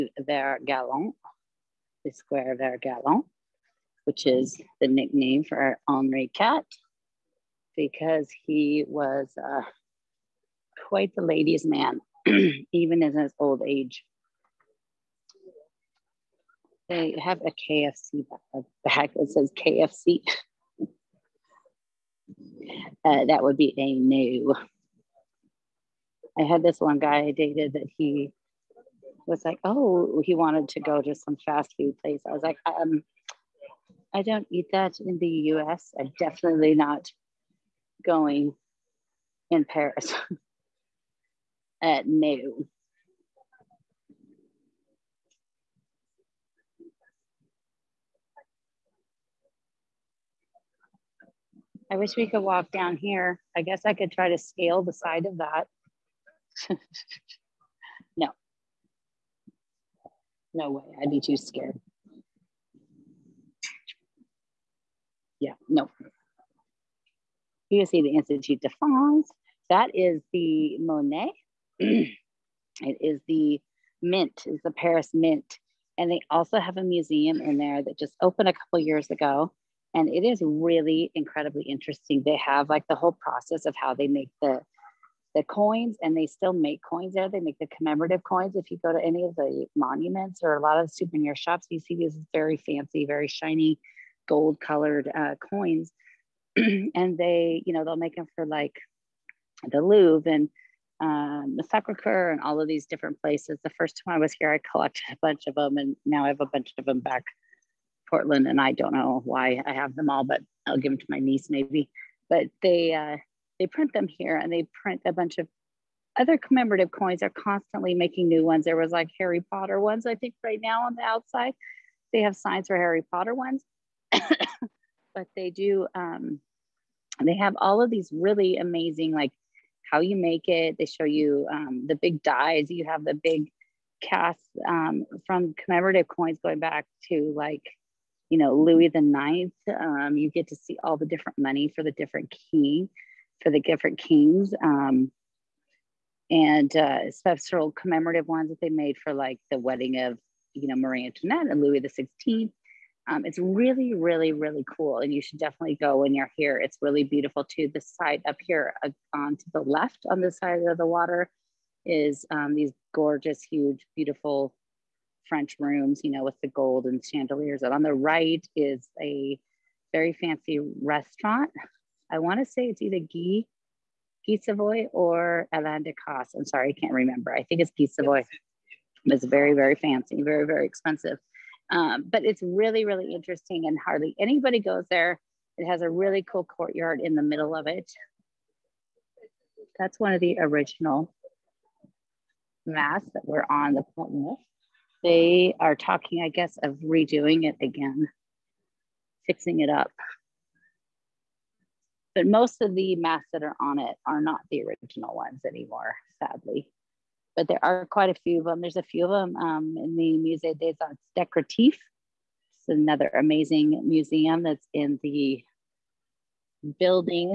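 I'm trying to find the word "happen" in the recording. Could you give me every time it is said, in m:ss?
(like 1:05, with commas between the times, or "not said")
not said.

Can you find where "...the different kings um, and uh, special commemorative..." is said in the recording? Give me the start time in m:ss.
2:23.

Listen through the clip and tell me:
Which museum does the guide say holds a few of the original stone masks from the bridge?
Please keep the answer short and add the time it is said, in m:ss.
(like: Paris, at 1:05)
Musée des Arts Décoratifs, at 3:30.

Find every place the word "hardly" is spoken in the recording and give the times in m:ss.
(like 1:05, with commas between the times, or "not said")
3:03.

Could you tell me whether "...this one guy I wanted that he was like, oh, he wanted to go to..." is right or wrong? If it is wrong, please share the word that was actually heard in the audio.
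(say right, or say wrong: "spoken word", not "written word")
wrong: "dated", not "wanted".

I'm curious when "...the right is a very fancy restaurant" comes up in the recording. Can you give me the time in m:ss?
2:47.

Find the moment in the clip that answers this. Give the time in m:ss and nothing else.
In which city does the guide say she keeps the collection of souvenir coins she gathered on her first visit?
1:48.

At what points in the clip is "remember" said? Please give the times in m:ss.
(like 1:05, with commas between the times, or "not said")
2:56.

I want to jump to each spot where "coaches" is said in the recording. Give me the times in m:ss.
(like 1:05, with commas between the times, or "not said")
not said.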